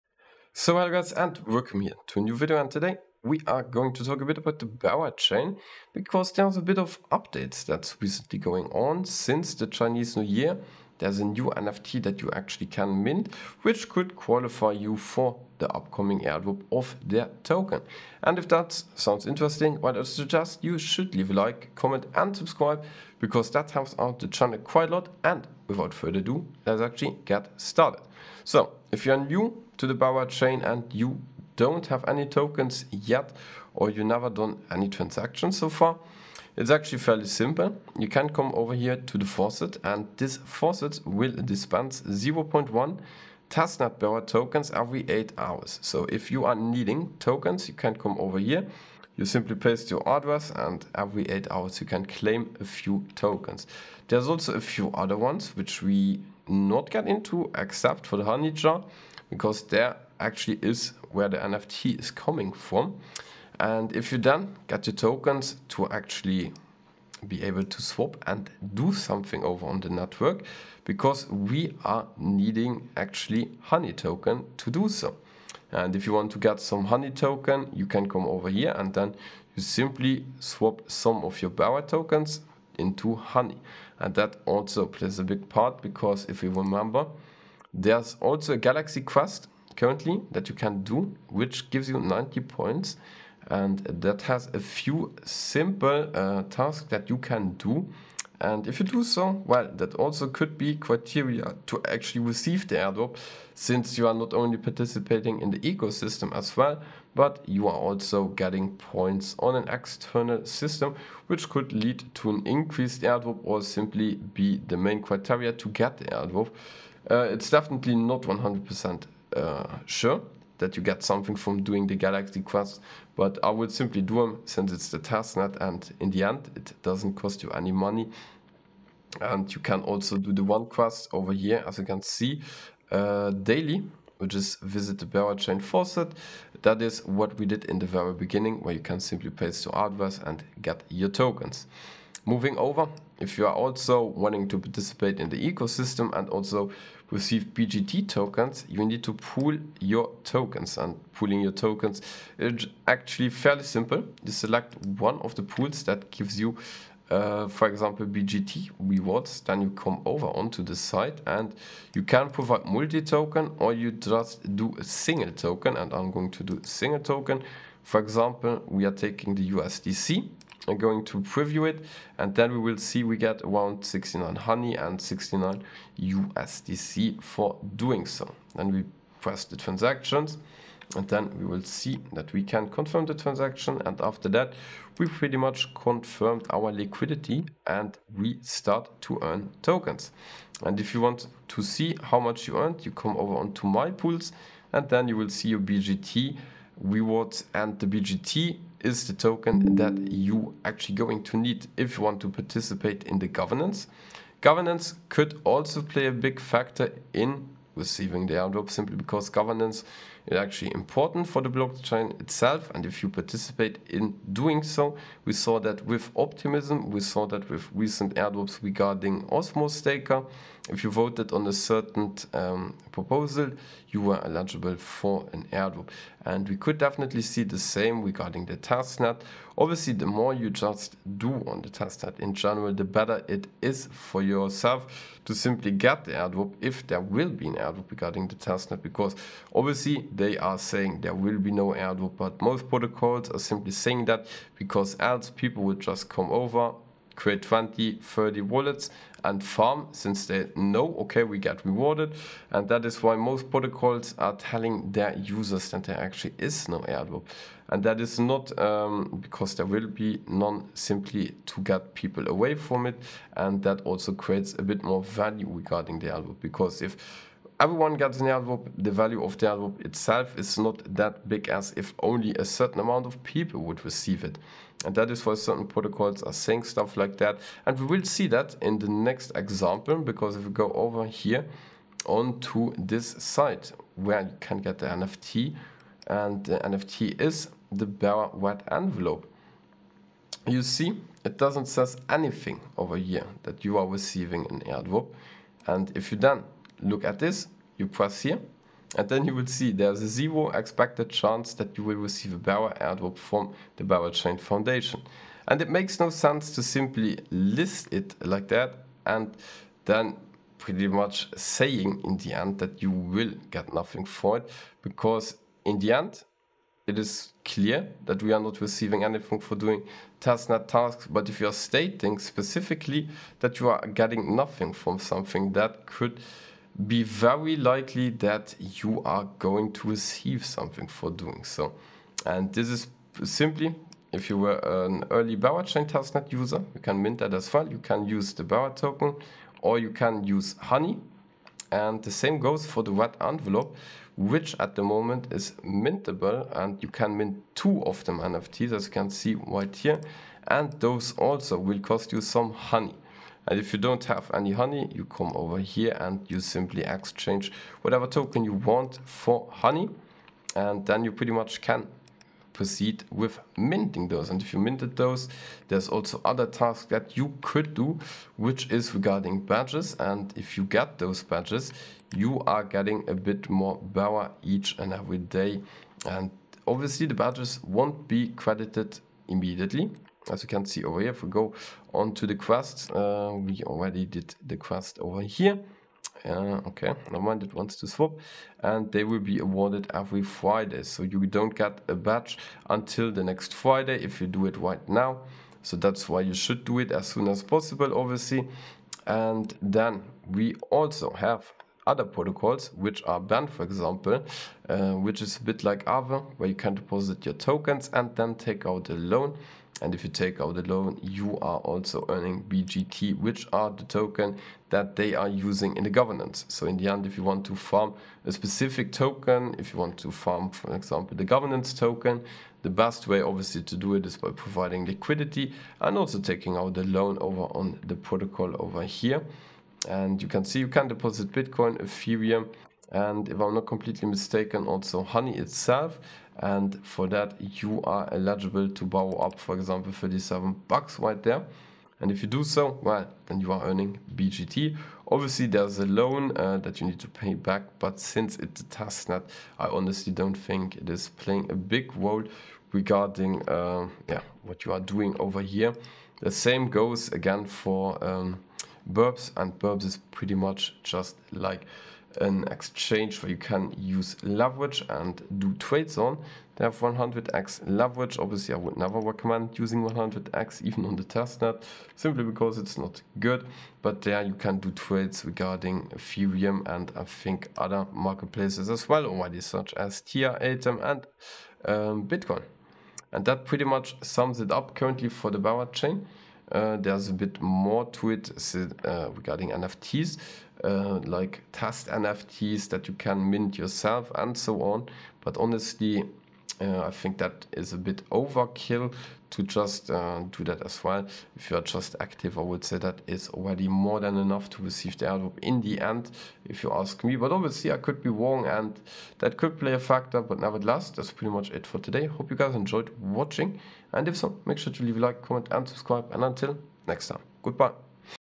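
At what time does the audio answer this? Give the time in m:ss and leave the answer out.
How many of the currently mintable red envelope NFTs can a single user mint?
5:47.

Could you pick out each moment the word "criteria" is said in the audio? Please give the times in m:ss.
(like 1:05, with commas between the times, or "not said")
1:40, 1:55.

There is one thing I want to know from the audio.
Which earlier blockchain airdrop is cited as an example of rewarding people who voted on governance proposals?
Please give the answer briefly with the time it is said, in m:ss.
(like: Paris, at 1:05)
Optimism, at 3:36.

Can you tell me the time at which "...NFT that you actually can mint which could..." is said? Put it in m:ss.
0:11.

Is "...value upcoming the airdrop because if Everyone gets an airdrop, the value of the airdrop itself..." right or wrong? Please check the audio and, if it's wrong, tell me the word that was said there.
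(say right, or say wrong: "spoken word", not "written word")
wrong: "regarding", not "upcoming".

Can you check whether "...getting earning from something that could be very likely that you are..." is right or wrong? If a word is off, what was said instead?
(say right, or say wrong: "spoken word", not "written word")
wrong: "nothing", not "earning".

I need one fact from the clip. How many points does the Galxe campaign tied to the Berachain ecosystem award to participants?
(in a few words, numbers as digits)
90.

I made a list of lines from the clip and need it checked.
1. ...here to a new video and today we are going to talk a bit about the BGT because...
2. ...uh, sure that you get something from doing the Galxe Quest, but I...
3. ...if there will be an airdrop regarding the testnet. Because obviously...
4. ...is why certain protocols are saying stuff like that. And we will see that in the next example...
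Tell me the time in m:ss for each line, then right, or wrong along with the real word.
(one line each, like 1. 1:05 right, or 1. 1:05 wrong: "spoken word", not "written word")
1. 0:01 wrong: "Berachain", not "BGT"
2. 1:59 right
3. 3:56 right
4. 4:35 right.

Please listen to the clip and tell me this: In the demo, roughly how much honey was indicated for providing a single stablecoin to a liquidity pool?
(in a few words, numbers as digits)
69.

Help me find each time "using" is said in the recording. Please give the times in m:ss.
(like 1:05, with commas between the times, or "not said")
6:55, 7:49.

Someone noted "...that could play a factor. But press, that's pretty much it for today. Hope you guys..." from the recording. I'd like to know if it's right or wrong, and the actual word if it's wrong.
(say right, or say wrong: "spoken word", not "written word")
wrong: "nevertheless", not "press".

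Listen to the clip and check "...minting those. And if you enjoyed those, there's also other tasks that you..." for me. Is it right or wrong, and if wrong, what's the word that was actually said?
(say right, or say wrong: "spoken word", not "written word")
wrong: "minted", not "enjoyed".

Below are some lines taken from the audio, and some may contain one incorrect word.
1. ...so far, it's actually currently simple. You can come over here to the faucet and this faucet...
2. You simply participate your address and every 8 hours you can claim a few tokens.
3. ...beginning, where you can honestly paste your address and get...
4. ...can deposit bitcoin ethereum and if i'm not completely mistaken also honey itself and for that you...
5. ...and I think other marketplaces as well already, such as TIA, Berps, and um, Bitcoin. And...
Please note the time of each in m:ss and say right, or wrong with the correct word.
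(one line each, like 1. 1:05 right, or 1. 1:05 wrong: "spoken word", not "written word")
1. 0:35 wrong: "fairly", not "currently"
2. 0:49 wrong: "paste", not "participate"
3. 2:18 wrong: "simply", not "honestly"
4. 7:10 right
5. 7:56 wrong: "Atom", not "Berps".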